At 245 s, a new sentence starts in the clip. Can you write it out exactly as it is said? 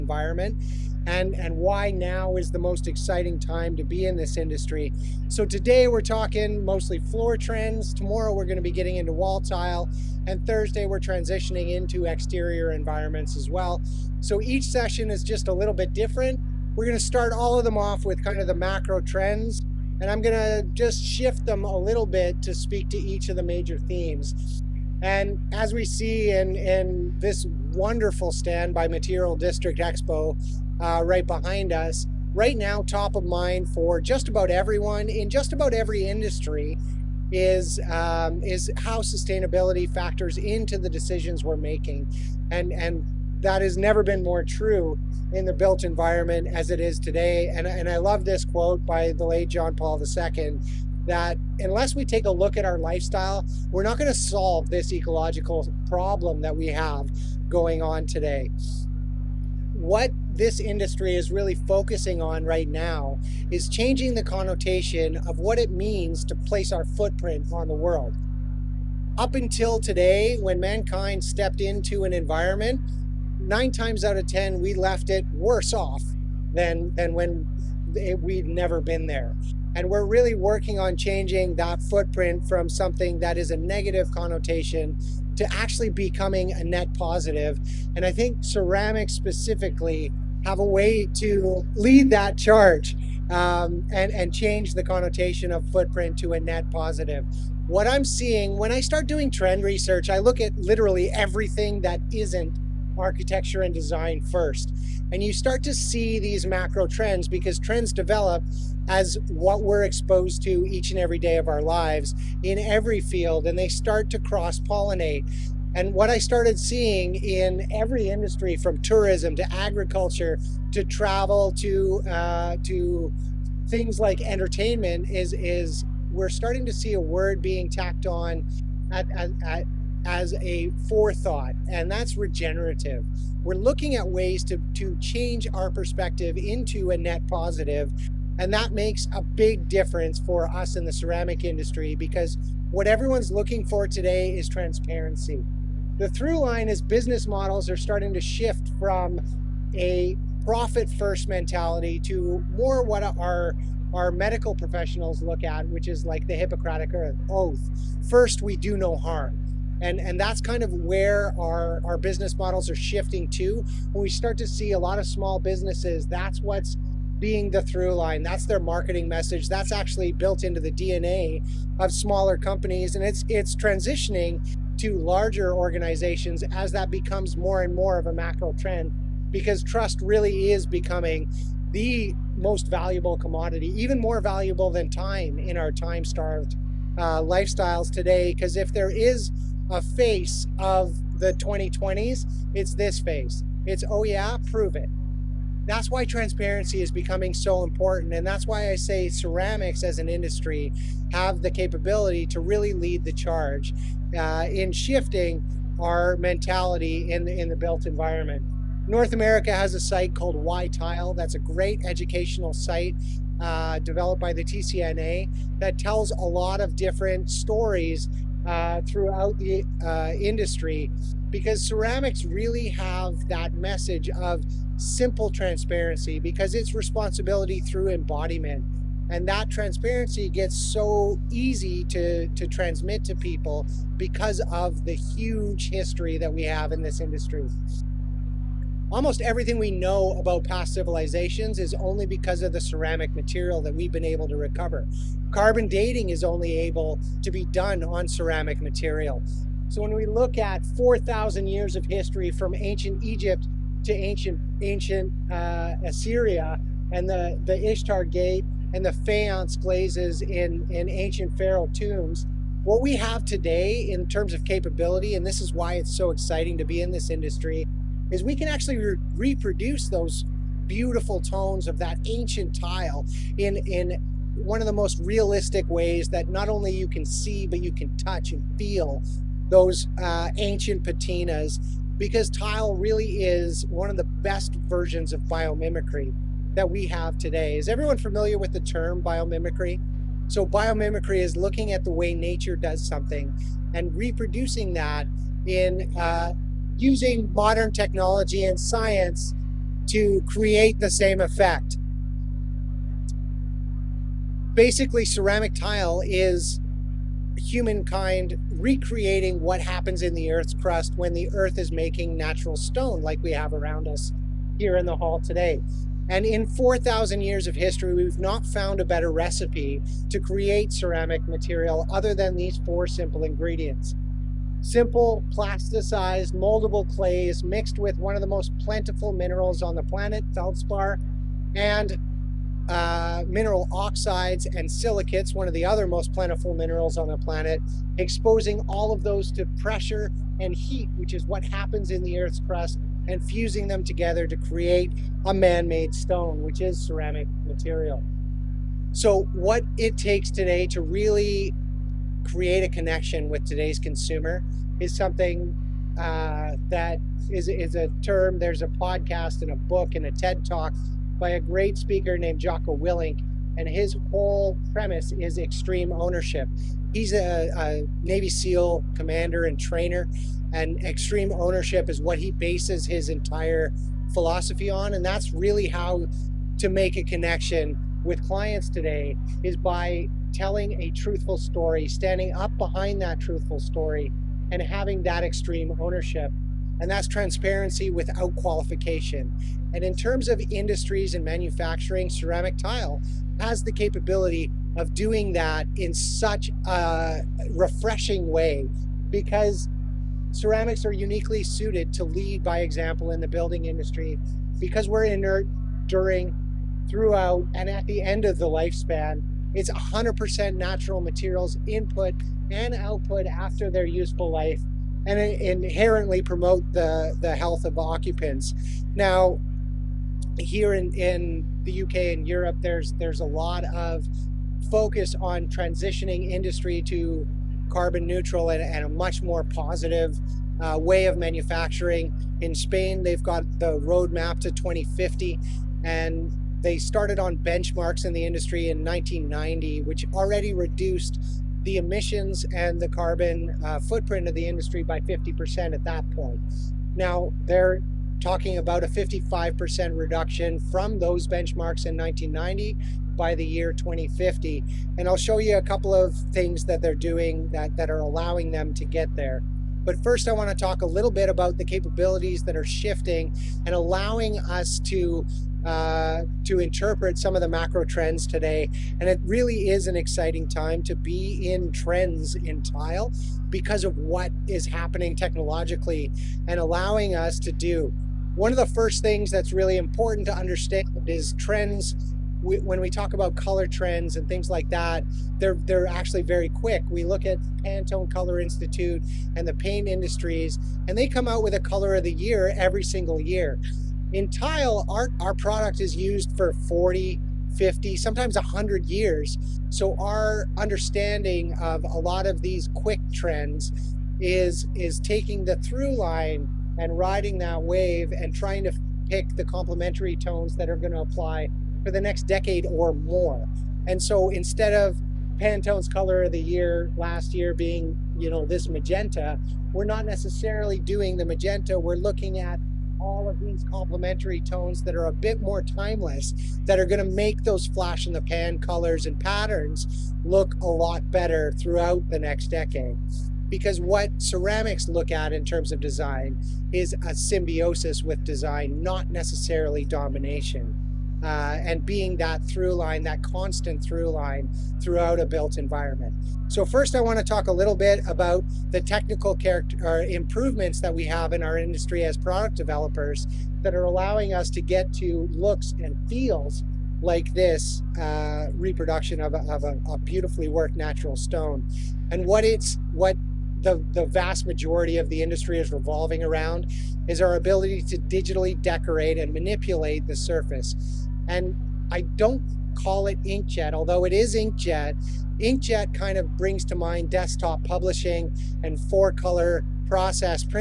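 Carbon dating is only able to be done on ceramic material.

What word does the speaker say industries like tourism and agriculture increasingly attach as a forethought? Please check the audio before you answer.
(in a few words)
Regenerative.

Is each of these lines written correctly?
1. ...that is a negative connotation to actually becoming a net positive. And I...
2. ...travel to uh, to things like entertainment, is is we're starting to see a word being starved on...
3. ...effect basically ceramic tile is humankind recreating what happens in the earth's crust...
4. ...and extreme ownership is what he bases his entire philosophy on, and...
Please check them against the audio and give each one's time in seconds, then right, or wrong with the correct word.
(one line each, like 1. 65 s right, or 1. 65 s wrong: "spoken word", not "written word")
1. 83 s right
2. 120 s wrong: "tacked", not "starved"
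3. 301 s right
4. 370 s right.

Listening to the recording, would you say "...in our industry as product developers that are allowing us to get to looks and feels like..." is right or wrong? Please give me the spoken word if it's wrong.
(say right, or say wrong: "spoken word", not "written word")
right.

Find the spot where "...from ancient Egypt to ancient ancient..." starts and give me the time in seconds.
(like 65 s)
252 s.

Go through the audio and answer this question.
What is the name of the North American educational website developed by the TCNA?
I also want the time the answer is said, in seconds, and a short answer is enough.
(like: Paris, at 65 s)
Why Tile, at 210 s.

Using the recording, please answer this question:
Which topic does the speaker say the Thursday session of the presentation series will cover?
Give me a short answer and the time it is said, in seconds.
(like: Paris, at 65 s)
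Exterior environments, at 12 s.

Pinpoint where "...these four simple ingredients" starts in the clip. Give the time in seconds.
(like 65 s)
322 s.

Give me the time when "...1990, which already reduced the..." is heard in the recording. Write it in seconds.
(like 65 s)
438 s.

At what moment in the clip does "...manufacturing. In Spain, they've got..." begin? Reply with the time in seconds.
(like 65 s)
431 s.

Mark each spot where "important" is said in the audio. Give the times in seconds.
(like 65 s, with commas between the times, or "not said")
197 s, 479 s.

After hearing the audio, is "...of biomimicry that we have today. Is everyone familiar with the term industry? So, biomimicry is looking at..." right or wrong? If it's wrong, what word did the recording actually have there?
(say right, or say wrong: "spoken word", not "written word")
wrong: "biomimicry", not "industry".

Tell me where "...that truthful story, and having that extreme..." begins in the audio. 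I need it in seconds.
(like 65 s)
383 s.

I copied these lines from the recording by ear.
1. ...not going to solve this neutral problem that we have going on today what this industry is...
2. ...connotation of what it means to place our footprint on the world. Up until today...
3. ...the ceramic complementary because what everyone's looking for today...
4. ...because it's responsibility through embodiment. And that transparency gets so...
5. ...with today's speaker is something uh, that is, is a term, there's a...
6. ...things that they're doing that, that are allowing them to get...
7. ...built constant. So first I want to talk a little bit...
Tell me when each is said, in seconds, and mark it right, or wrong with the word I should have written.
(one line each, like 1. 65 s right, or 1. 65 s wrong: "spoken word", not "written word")
1. 53 s wrong: "ecological", not "neutral"
2. 64 s right
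3. 140 s wrong: "industry", not "complementary"
4. 226 s right
5. 353 s wrong: "consumer", not "speaker"
6. 456 s right
7. 545 s wrong: "environment", not "constant".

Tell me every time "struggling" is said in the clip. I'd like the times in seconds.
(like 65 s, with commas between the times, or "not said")
not said.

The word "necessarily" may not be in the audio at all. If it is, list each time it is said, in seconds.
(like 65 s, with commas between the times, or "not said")
520 s, 539 s.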